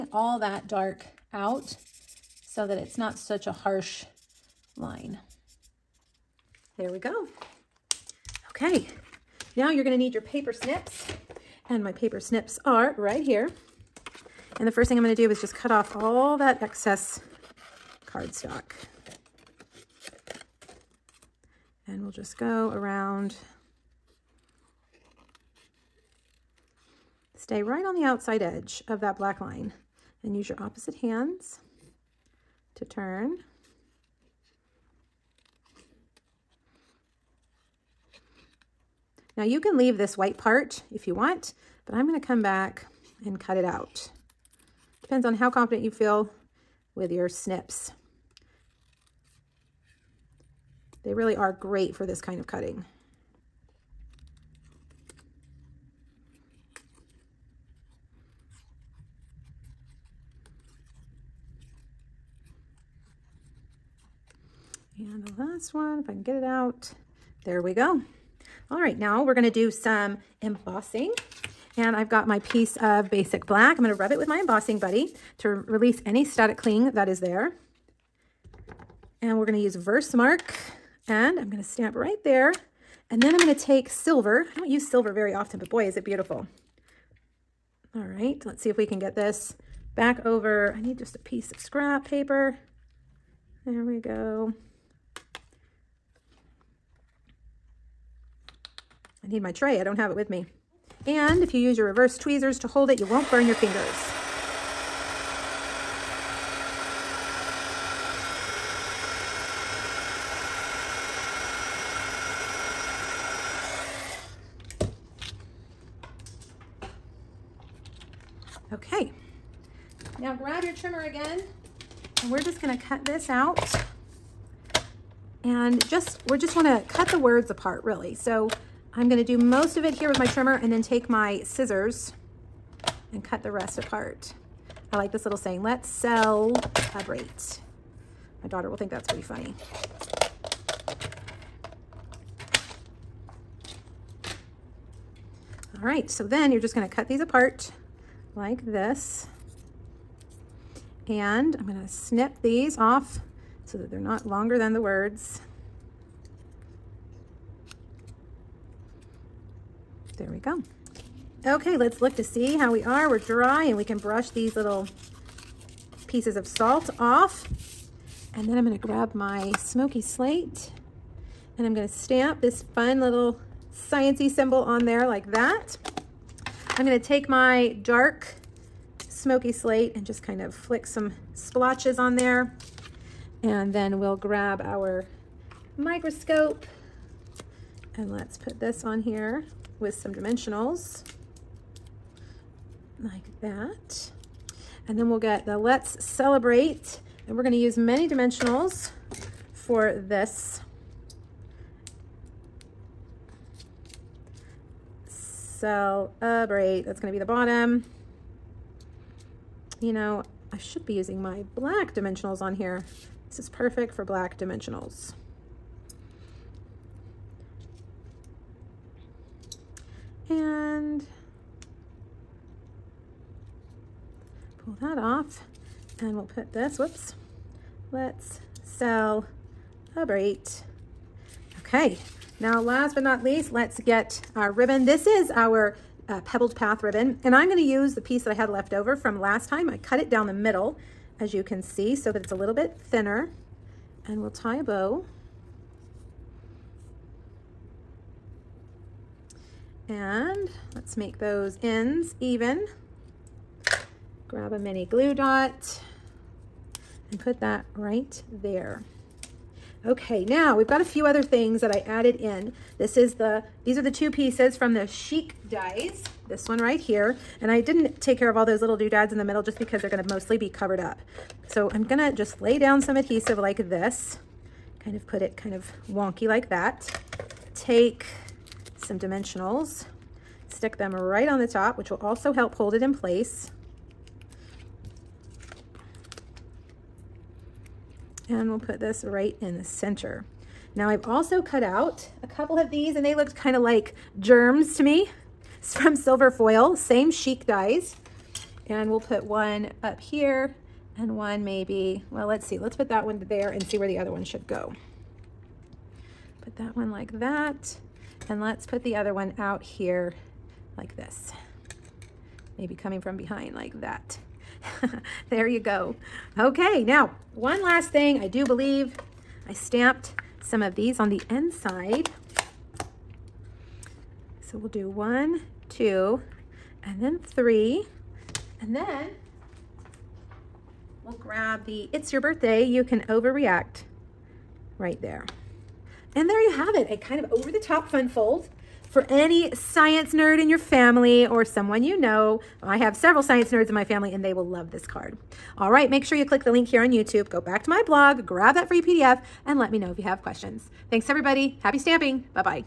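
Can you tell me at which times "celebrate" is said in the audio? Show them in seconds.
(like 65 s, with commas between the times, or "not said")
136 s, 196 s, 205 s.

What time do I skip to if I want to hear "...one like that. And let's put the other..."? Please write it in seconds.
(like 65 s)
306 s.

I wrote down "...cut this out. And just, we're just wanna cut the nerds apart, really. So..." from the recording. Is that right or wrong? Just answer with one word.
wrong.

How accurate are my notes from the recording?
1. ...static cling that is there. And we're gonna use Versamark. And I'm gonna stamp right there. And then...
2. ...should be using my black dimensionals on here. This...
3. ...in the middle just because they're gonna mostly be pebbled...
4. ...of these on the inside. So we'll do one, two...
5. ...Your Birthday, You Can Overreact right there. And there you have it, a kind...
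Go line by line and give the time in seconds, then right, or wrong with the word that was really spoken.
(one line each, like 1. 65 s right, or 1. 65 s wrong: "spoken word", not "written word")
1. 76 s right
2. 210 s right
3. 269 s wrong: "covered", not "pebbled"
4. 320 s right
5. 332 s right.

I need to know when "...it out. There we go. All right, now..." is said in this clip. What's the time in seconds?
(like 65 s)
66 s.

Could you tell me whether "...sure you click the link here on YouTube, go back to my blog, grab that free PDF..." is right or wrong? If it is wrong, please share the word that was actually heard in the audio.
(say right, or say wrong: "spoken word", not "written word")
right.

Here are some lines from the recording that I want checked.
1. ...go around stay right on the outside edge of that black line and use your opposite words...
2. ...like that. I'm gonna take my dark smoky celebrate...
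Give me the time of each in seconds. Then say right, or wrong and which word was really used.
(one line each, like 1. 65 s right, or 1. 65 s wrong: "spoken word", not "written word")
1. 22 s wrong: "hands", not "words"
2. 175 s wrong: "slate", not "celebrate".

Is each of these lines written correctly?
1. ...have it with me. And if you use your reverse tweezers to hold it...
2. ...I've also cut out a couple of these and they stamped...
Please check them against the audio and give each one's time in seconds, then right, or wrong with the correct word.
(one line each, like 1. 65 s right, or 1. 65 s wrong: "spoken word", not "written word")
1. 99 s right
2. 290 s wrong: "looked", not "stamped".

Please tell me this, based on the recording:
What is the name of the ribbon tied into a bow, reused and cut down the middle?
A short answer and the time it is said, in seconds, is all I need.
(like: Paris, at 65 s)
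Pebbled Path, at 236 s.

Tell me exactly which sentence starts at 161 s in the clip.
Okay, let's look to see how we are.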